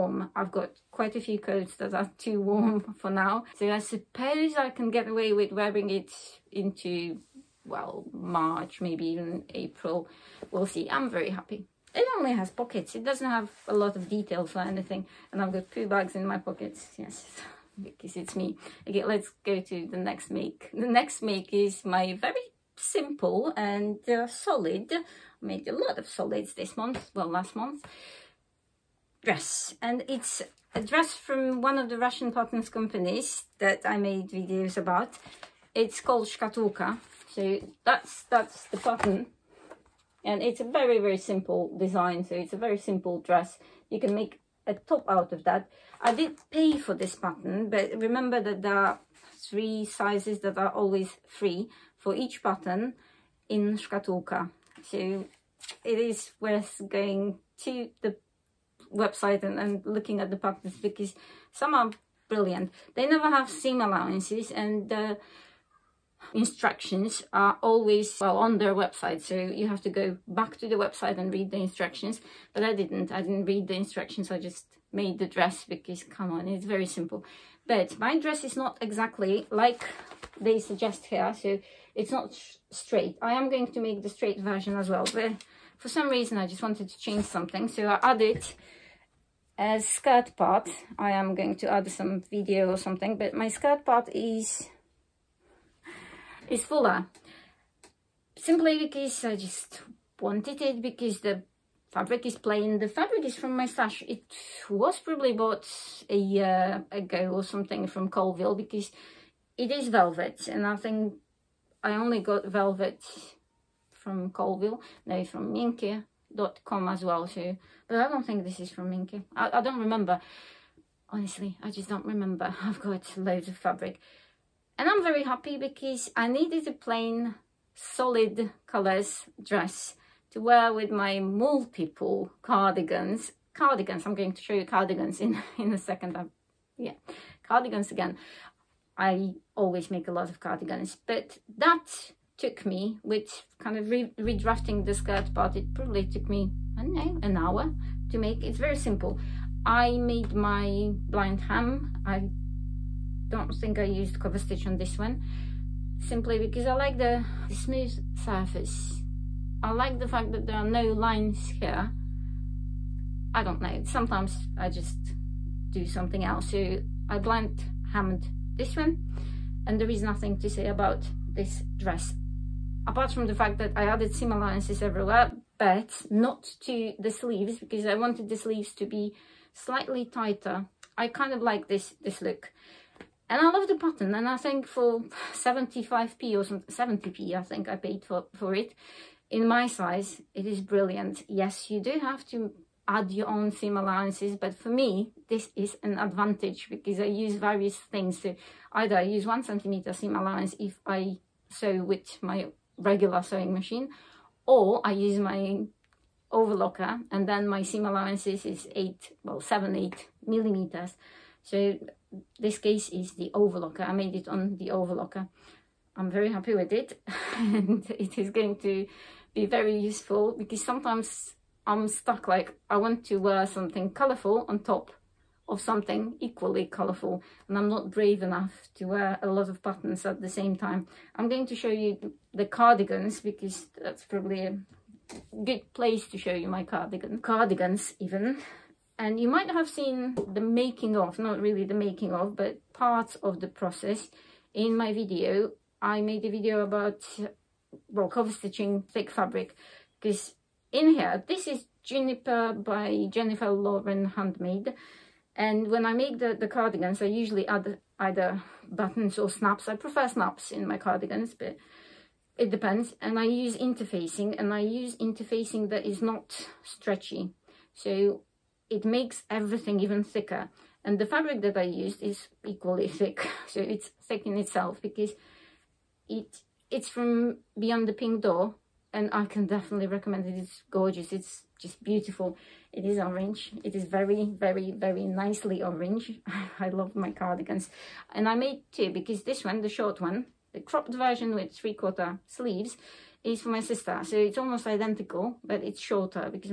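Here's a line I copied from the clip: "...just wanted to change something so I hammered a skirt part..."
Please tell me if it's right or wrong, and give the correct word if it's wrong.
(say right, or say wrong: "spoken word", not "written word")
wrong: "added", not "hammered".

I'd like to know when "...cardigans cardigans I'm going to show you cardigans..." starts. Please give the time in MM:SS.
02:12.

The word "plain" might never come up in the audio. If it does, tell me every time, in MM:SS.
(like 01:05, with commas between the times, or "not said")
01:42, 02:06.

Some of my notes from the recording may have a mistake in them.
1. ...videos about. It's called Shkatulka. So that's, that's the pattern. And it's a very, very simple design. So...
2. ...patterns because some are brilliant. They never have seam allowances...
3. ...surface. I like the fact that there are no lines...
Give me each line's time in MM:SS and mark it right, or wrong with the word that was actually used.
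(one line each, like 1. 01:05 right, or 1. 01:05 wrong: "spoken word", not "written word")
1. 00:34 right
2. 01:00 right
3. 02:38 right.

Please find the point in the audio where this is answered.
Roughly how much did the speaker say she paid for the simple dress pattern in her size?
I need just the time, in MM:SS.
03:06.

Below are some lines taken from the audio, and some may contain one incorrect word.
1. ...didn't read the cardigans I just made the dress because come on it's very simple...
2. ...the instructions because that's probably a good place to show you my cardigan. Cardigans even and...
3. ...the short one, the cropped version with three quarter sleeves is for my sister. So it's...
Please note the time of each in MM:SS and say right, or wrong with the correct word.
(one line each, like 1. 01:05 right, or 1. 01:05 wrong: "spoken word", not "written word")
1. 01:13 wrong: "instructions", not "cardigans"
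2. 03:52 wrong: "cardigans", not "instructions"
3. 04:49 right.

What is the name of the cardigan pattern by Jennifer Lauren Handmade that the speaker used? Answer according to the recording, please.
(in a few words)
Juniper.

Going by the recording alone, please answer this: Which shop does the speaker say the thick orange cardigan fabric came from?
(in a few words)
Beyond the Pink Door.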